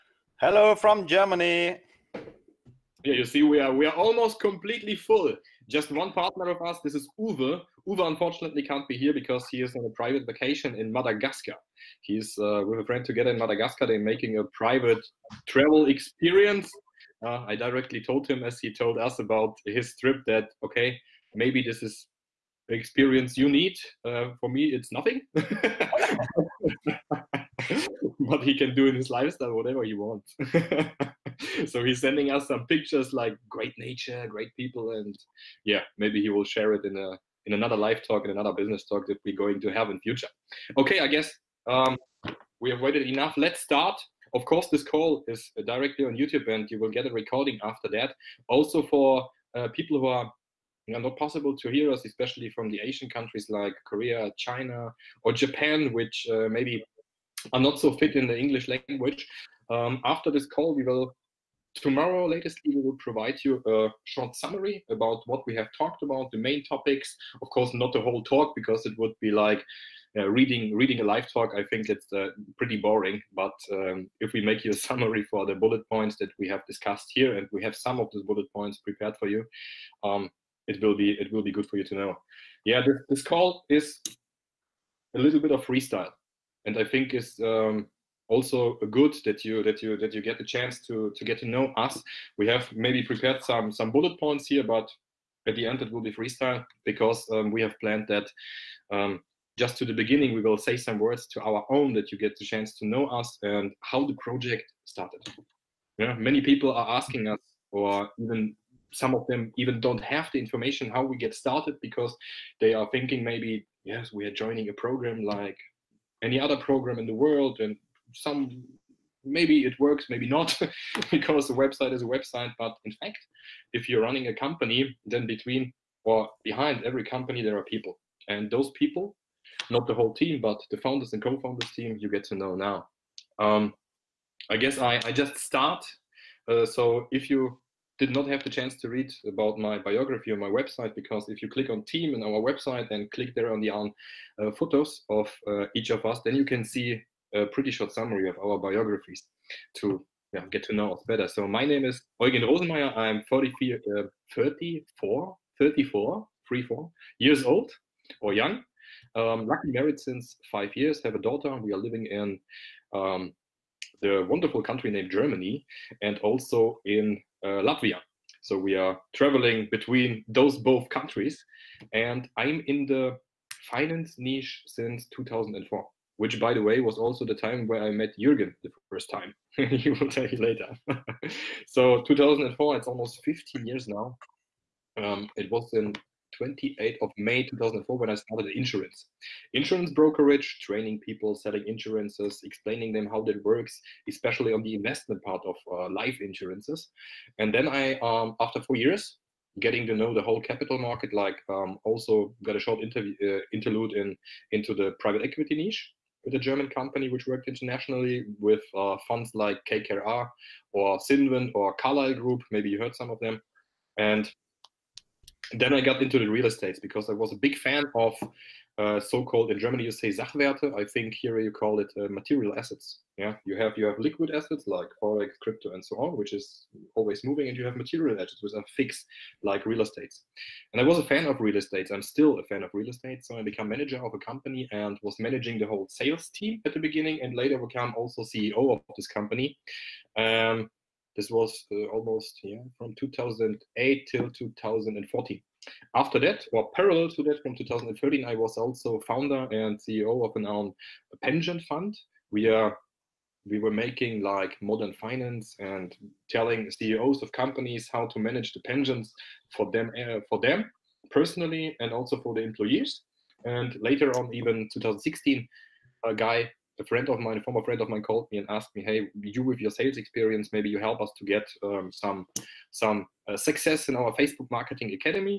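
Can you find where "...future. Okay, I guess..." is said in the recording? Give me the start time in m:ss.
0:39.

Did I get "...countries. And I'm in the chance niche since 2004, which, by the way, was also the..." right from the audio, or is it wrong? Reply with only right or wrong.
wrong.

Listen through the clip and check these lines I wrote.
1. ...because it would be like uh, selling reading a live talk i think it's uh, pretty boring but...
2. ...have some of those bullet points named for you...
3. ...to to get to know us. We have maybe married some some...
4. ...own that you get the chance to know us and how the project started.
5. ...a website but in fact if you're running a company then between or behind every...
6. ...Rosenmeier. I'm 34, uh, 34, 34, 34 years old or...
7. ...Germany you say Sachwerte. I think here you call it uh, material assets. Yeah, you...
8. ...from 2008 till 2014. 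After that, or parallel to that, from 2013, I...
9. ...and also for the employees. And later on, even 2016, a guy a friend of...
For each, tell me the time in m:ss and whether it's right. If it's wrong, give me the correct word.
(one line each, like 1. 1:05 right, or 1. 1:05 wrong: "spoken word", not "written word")
1. 1:08 wrong: "reading", not "selling"
2. 1:17 wrong: "prepared", not "named"
3. 1:30 wrong: "prepared", not "married"
4. 1:41 right
5. 2:02 right
6. 2:32 right
7. 3:39 right
8. 4:02 right
9. 4:21 right.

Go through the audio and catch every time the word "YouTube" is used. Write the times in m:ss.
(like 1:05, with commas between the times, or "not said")
0:46.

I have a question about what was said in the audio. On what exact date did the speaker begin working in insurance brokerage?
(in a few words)
28 May 2004.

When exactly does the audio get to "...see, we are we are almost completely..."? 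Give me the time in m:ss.
0:03.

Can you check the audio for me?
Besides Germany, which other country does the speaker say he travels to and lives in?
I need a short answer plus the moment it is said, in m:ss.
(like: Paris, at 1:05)
Latvia, at 2:47.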